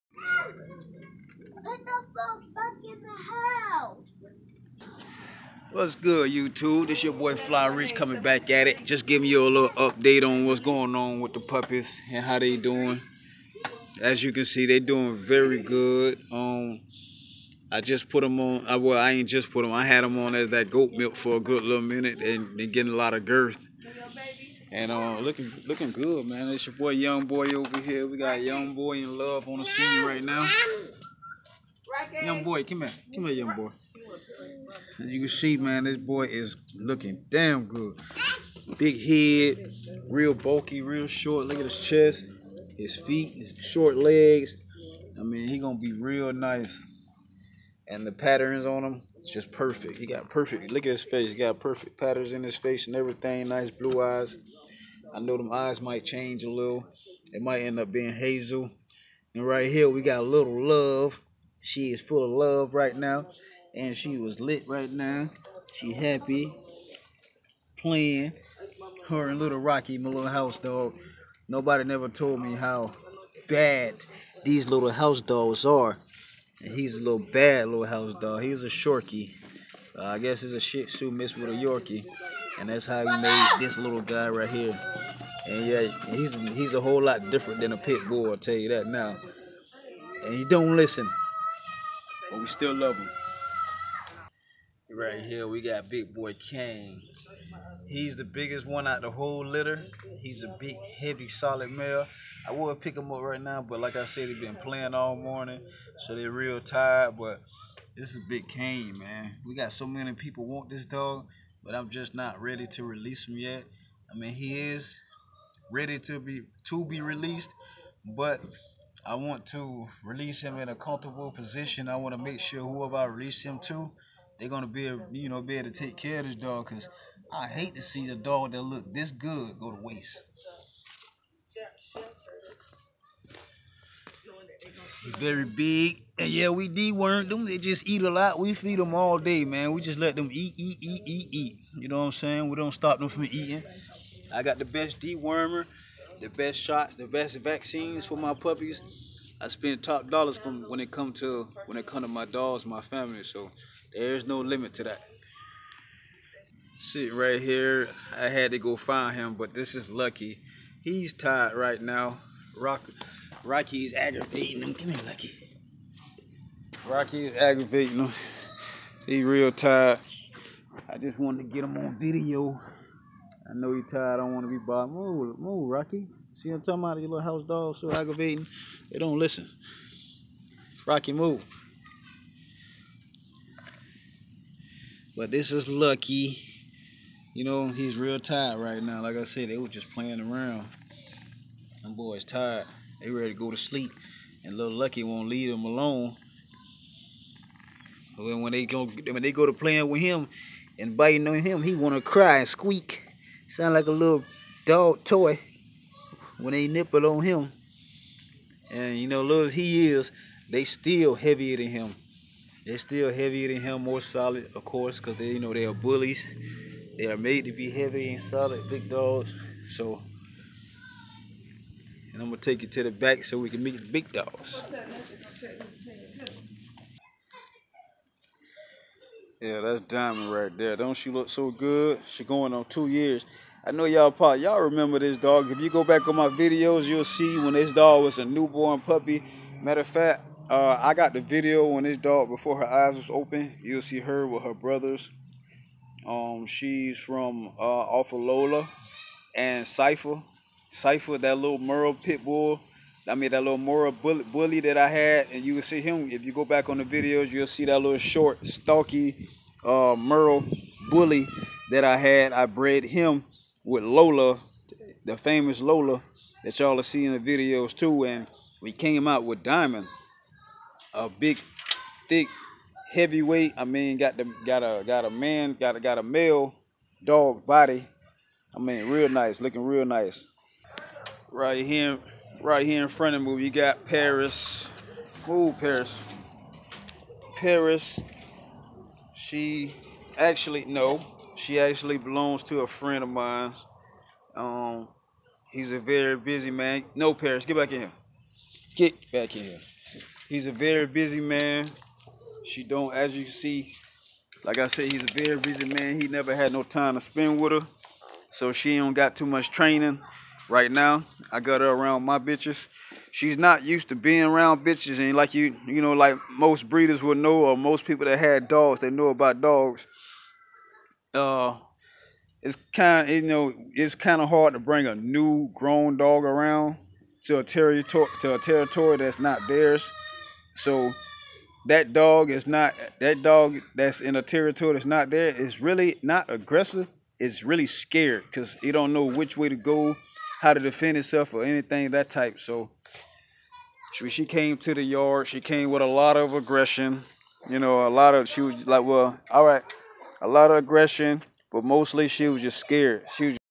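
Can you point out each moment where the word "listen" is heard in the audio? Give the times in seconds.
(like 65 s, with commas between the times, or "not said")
90 s, 179 s.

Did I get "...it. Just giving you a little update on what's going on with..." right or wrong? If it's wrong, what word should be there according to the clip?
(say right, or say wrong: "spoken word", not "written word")
right.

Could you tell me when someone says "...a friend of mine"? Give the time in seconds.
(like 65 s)
292 s.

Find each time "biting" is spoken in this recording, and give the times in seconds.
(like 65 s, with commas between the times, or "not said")
200 s.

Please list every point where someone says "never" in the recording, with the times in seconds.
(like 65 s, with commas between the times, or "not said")
71 s, 306 s.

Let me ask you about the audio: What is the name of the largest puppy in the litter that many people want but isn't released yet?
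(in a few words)
Big Boy Kane.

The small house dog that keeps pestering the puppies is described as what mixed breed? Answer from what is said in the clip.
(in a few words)
Shorkie.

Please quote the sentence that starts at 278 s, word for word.
I mean, real nice, looking real nice.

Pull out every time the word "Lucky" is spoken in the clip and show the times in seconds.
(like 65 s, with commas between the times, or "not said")
159 s, 165 s, 185 s, 194 s.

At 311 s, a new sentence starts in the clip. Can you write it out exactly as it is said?
I got her around my bitches.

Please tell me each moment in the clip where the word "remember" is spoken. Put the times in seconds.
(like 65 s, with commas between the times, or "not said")
234 s.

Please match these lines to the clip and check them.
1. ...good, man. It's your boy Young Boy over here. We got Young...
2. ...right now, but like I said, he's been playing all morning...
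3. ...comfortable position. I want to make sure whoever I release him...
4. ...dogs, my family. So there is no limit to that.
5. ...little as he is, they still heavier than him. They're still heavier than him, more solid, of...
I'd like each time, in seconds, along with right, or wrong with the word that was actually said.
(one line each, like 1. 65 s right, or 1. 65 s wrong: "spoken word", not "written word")
1. 25 s right
2. 103 s right
3. 120 s right
4. 152 s right
5. 209 s right.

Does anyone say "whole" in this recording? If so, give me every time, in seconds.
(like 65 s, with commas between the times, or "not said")
86 s, 99 s.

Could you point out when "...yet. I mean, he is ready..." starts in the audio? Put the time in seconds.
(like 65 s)
113 s.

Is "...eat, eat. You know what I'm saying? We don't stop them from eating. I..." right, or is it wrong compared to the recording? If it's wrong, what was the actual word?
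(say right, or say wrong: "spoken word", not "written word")
right.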